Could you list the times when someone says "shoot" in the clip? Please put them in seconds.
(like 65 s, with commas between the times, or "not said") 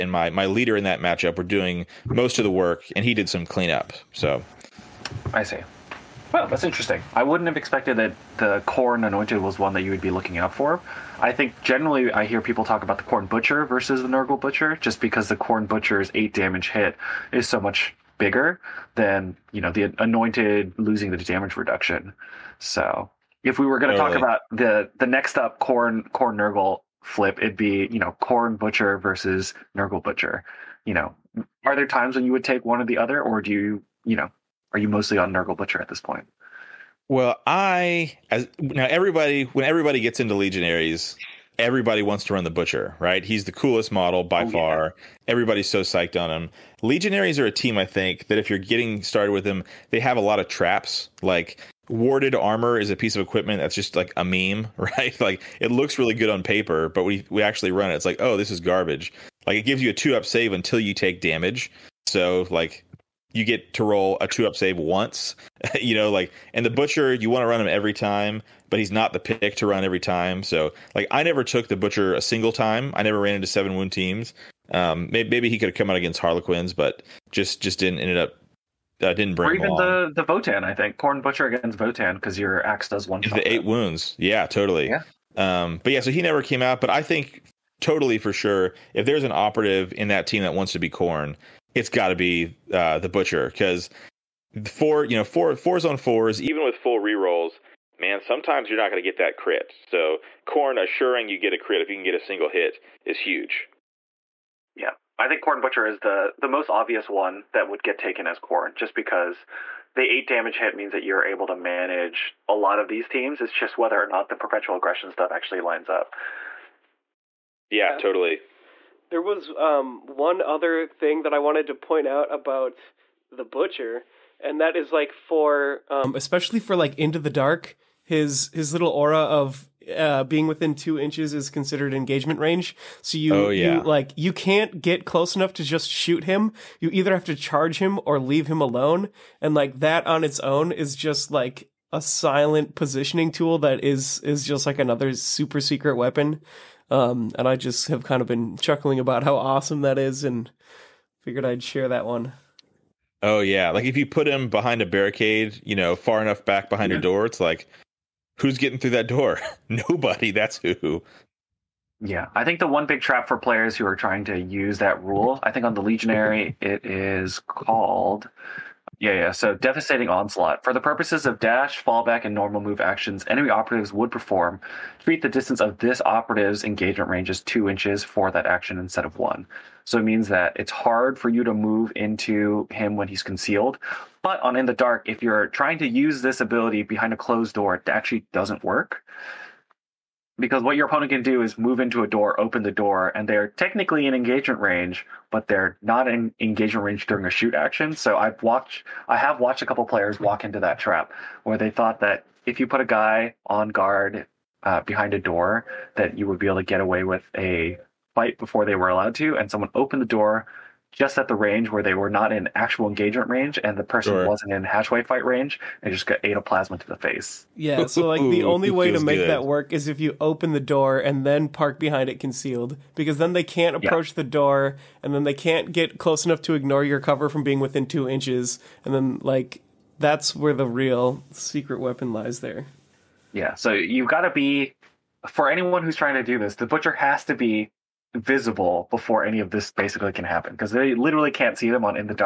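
135 s, 197 s.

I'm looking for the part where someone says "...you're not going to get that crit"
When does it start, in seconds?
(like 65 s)
98 s.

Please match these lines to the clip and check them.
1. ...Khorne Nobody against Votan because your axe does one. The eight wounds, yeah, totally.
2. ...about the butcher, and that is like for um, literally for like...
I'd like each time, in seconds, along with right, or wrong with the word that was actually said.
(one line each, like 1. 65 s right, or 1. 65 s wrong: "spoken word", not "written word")
1. 80 s wrong: "Butcher", not "Nobody"
2. 122 s wrong: "especially", not "literally".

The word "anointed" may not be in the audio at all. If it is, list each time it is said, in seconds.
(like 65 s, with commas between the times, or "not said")
9 s, 19 s.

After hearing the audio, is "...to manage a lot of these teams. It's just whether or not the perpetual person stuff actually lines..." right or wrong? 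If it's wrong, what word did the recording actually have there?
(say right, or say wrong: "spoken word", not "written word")
wrong: "aggression", not "person".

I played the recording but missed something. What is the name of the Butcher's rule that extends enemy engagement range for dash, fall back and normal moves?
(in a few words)
Devastating onslaught.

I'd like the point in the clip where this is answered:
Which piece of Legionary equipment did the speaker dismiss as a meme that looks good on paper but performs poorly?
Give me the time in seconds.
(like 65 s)
51 s.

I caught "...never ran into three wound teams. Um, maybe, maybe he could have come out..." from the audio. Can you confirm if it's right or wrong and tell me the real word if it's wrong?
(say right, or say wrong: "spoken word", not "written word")
wrong: "seven", not "three".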